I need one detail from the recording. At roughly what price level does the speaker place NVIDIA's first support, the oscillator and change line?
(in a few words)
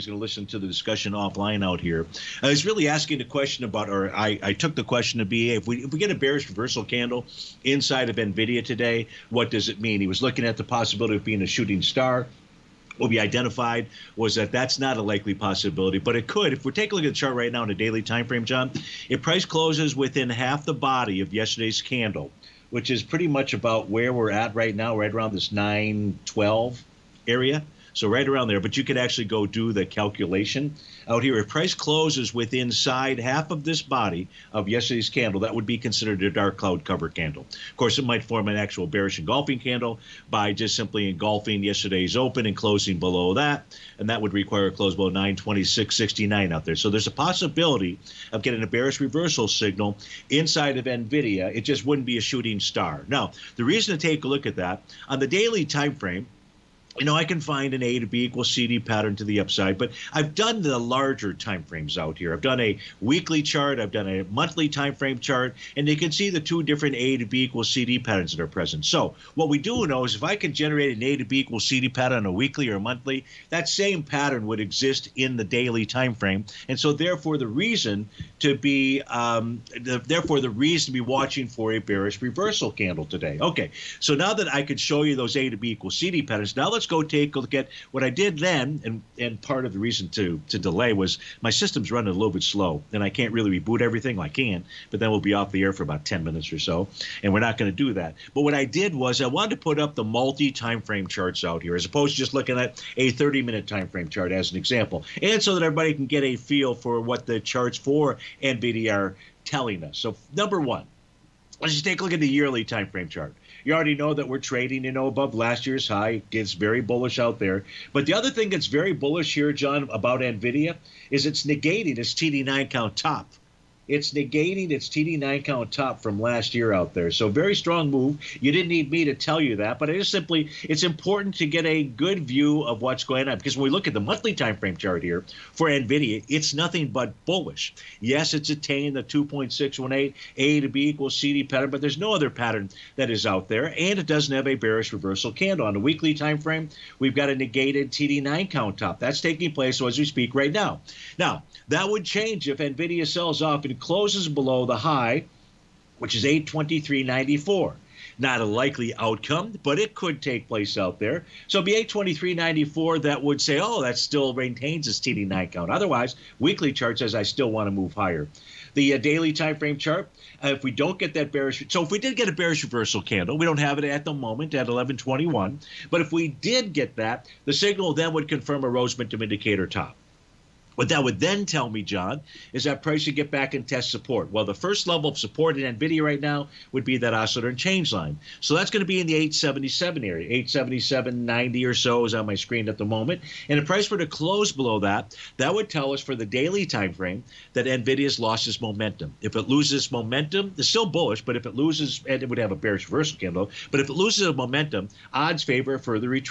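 877.90.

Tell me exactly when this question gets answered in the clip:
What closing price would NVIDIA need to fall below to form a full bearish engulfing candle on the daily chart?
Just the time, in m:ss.
0:45.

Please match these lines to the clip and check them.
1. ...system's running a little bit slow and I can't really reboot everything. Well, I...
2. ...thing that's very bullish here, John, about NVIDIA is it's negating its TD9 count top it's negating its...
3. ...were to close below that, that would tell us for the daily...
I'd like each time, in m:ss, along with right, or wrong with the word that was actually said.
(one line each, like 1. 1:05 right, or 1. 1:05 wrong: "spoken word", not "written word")
1. 1:31 right
2. 1:58 right
3. 3:13 right.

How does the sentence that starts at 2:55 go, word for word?
But if we did get that, the signal then would confirm a Rhodes Momentum indicator top.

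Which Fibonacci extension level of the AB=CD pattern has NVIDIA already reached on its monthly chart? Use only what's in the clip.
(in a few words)
2.618.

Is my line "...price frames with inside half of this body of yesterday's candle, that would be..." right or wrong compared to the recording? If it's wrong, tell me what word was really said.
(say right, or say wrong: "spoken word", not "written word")
wrong: "closes", not "frames".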